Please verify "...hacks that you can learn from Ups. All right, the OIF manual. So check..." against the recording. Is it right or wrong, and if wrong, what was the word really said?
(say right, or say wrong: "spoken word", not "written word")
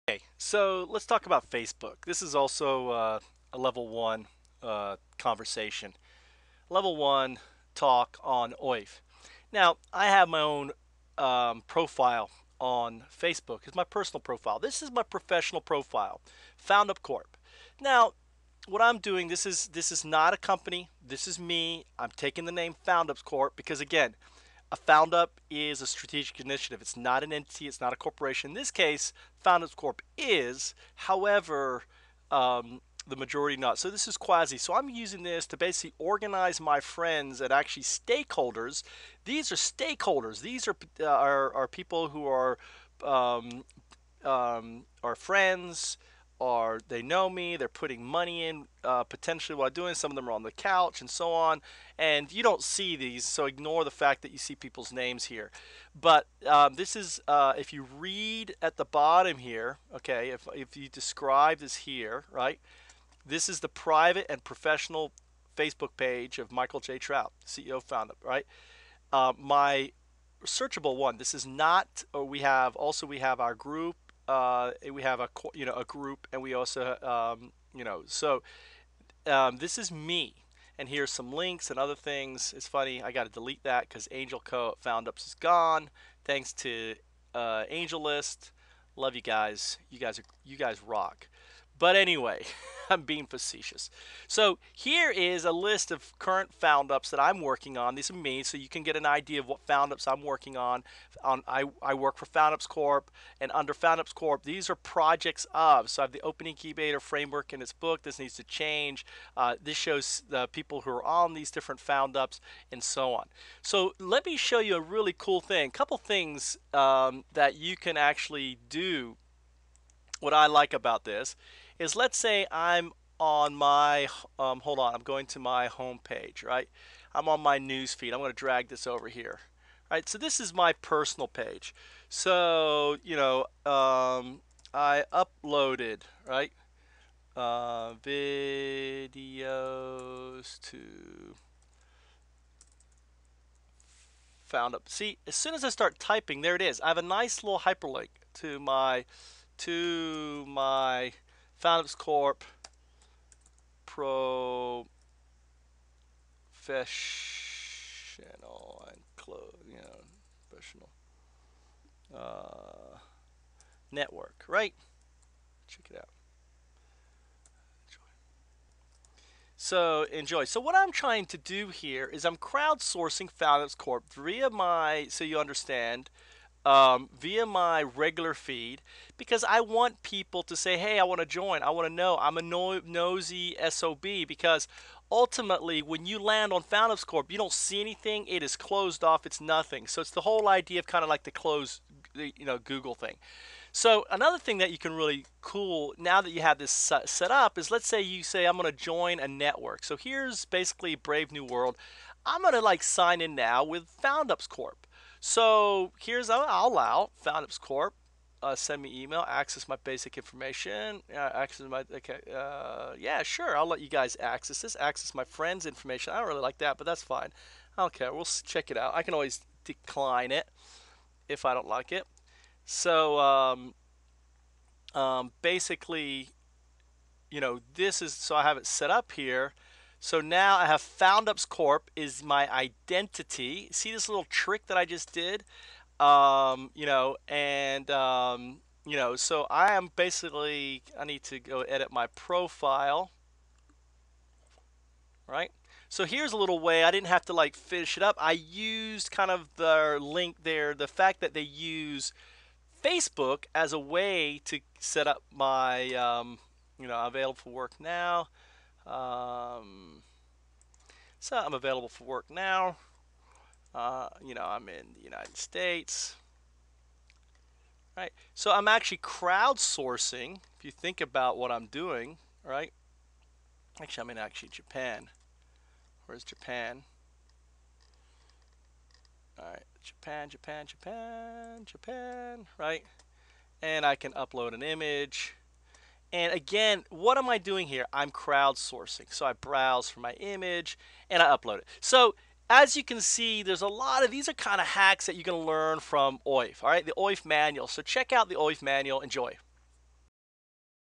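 wrong: "OIF", not "Ups".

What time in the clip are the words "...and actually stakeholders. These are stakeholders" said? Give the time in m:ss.
0:37.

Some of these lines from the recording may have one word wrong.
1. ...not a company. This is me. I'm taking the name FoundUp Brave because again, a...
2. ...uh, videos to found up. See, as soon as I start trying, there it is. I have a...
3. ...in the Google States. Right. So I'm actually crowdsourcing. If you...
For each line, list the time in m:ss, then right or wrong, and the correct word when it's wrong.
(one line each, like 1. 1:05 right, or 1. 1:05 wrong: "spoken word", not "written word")
1. 0:20 wrong: "Corp", not "Brave"
2. 2:17 wrong: "typing", not "trying"
3. 4:24 wrong: "United", not "Google".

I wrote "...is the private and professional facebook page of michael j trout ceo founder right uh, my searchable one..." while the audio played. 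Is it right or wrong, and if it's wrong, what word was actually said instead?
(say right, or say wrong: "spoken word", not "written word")
right.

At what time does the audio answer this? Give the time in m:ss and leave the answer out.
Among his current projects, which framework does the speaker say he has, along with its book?
1:46.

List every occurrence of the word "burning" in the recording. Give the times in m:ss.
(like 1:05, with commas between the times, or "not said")
not said.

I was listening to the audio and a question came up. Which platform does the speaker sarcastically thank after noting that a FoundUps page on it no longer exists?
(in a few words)
AngelList.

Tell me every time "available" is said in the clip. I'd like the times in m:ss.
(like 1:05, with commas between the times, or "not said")
4:17, 4:21.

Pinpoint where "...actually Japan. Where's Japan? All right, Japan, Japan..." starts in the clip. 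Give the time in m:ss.
4:34.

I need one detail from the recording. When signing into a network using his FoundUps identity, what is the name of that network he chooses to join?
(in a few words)
Brave New World.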